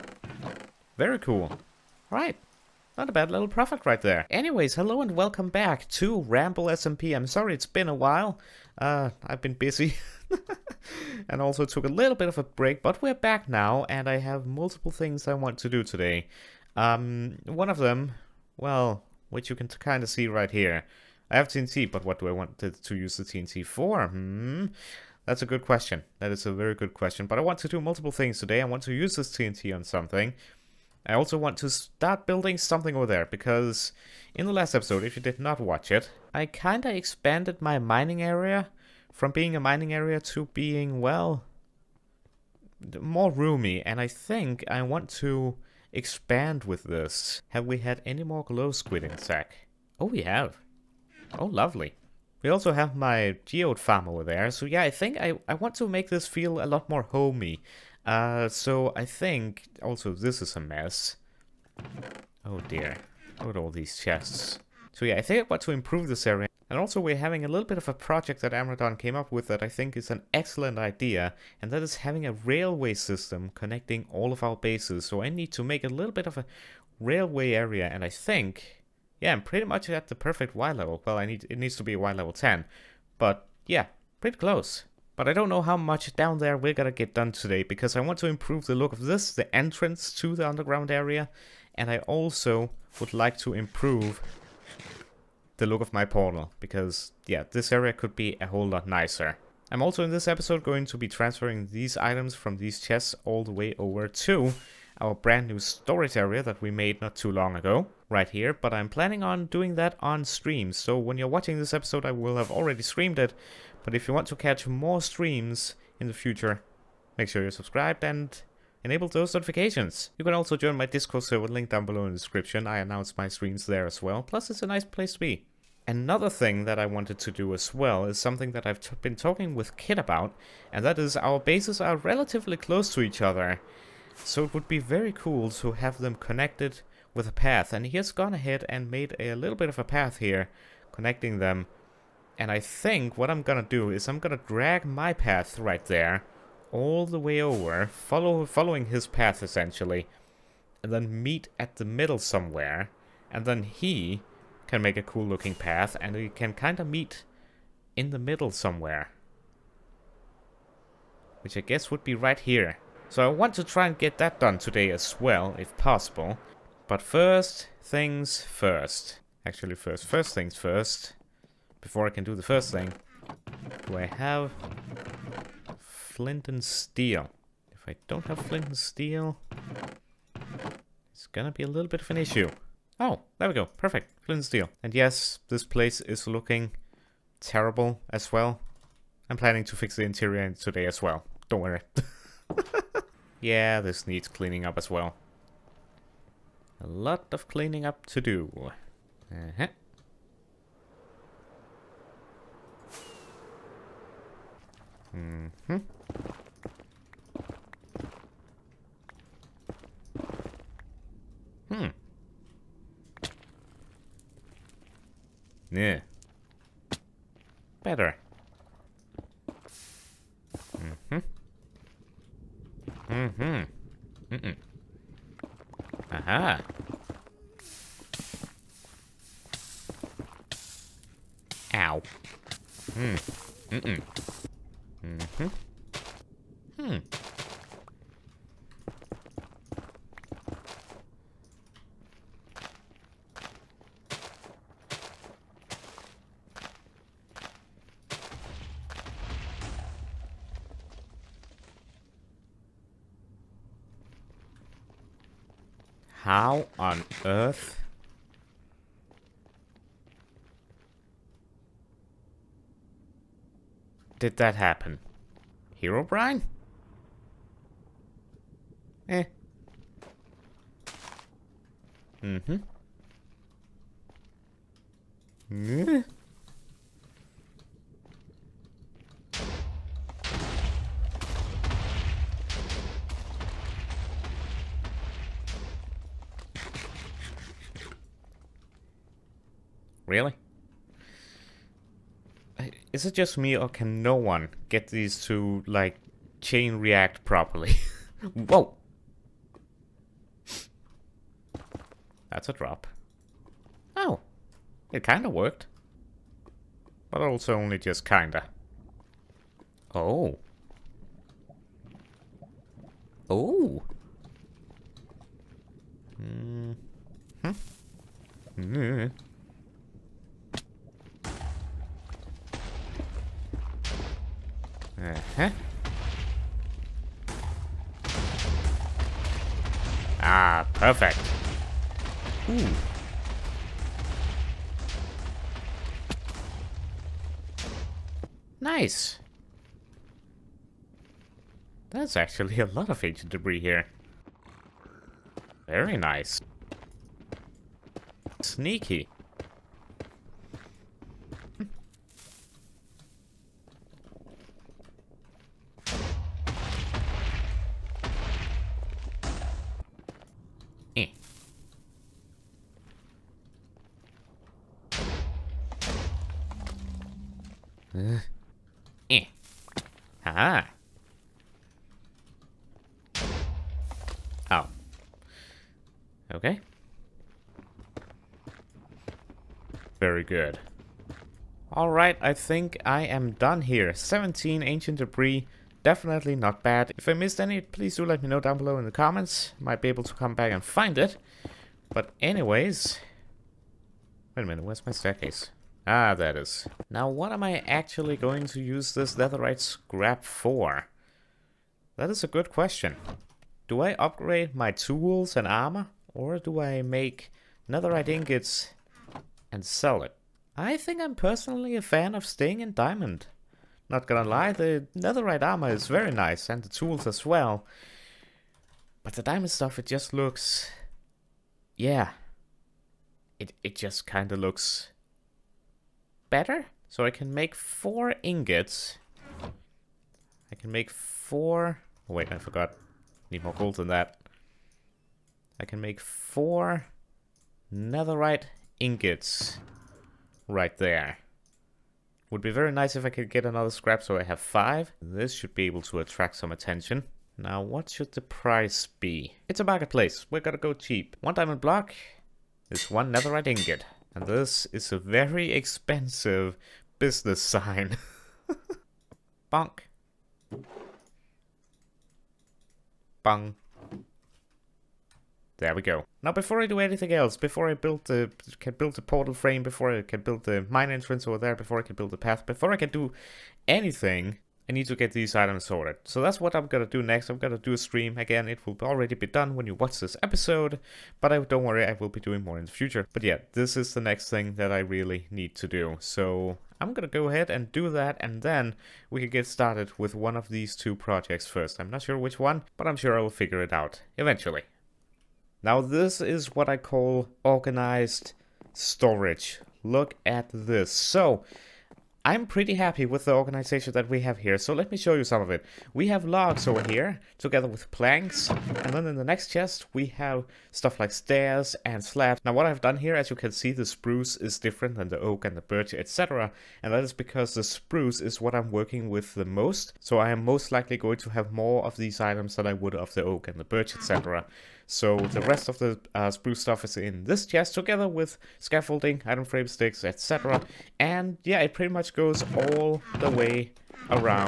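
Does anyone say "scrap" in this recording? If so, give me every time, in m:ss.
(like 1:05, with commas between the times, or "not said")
6:39, 7:23.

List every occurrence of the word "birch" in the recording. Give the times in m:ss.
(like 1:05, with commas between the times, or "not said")
8:35, 8:43.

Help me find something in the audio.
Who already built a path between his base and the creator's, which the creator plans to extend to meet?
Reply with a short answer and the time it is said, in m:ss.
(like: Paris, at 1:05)
Kit, at 2:09.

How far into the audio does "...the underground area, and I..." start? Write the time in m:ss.
1:30.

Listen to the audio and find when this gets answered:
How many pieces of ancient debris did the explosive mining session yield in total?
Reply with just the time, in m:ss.
6:23.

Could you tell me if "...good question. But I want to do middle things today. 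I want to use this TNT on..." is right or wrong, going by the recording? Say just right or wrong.
wrong.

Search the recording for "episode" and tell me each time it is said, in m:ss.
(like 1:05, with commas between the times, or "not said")
0:34, 1:40, 1:51, 8:00.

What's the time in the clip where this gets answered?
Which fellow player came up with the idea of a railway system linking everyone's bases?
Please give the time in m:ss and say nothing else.
1:08.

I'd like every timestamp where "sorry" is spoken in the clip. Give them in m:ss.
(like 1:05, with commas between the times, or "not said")
0:07.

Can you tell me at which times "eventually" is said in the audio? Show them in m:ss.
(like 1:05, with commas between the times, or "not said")
8:14.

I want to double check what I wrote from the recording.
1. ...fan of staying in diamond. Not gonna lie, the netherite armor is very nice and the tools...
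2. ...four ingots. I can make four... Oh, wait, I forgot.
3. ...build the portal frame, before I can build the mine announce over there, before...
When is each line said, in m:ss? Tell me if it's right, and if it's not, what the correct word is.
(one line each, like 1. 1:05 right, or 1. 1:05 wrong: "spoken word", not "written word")
1. 6:51 right
2. 7:07 right
3. 7:48 wrong: "entrance", not "announce".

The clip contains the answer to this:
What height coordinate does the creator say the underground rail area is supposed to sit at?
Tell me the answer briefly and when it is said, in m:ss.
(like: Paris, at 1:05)
Y level 10, at 1:21.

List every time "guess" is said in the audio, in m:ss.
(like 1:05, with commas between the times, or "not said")
2:41.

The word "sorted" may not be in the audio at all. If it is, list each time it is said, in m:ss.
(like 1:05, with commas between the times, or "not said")
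7:55.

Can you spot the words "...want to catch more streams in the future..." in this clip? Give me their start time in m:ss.
1:54.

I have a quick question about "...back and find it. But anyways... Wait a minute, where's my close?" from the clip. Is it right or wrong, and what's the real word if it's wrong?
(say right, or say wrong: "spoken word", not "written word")
wrong: "staircase", not "close".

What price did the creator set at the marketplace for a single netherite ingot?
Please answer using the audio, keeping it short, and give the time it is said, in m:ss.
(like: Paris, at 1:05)
One diamond block, at 7:31.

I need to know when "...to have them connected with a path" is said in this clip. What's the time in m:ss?
2:15.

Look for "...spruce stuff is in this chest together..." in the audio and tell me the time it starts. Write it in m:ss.
8:46.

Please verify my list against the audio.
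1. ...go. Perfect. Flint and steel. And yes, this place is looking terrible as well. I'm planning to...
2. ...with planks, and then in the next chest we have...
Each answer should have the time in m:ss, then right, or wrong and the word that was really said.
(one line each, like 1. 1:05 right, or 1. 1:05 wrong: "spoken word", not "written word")
1. 3:03 right
2. 8:27 right.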